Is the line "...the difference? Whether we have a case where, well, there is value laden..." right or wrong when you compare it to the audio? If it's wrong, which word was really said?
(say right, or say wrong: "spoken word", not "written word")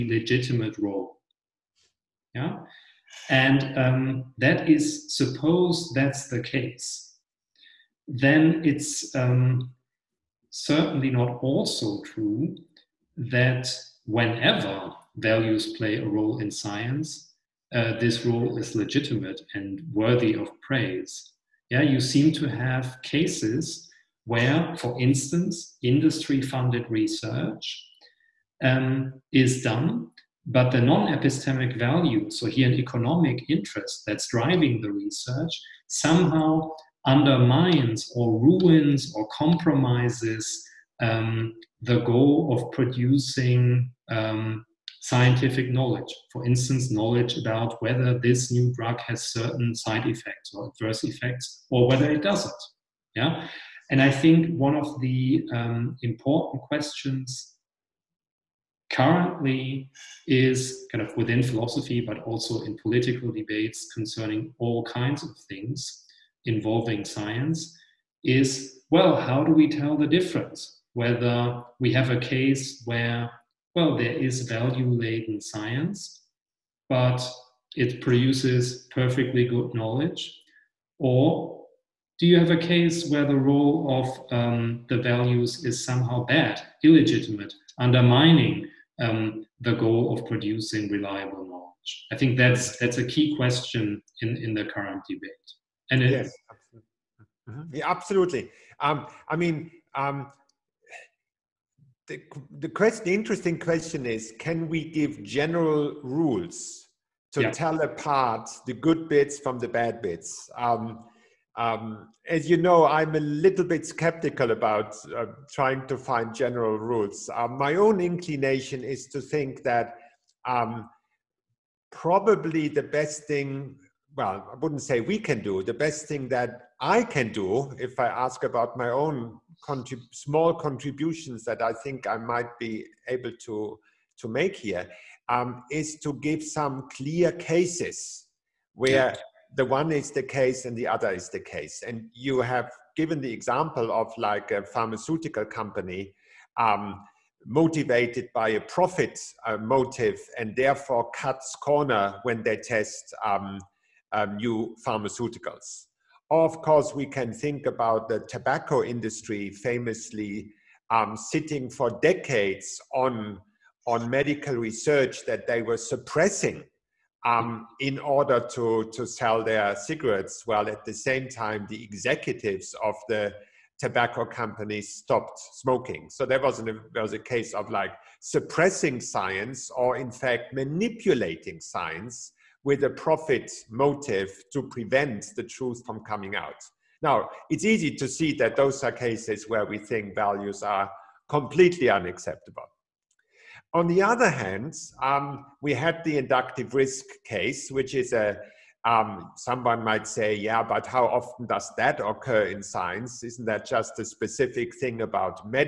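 right.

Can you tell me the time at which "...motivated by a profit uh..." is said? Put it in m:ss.
2:27.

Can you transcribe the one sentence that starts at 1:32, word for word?
I think that's that's a key question in, in the current debate.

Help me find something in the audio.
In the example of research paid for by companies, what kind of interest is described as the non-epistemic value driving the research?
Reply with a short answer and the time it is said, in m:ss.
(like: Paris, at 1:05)
economic interest, at 0:32.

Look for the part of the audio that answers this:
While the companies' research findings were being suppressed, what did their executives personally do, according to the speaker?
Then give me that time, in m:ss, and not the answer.
2:54.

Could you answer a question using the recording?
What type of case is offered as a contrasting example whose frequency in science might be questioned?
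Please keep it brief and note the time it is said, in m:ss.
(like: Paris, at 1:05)
inductive risk, at 3:16.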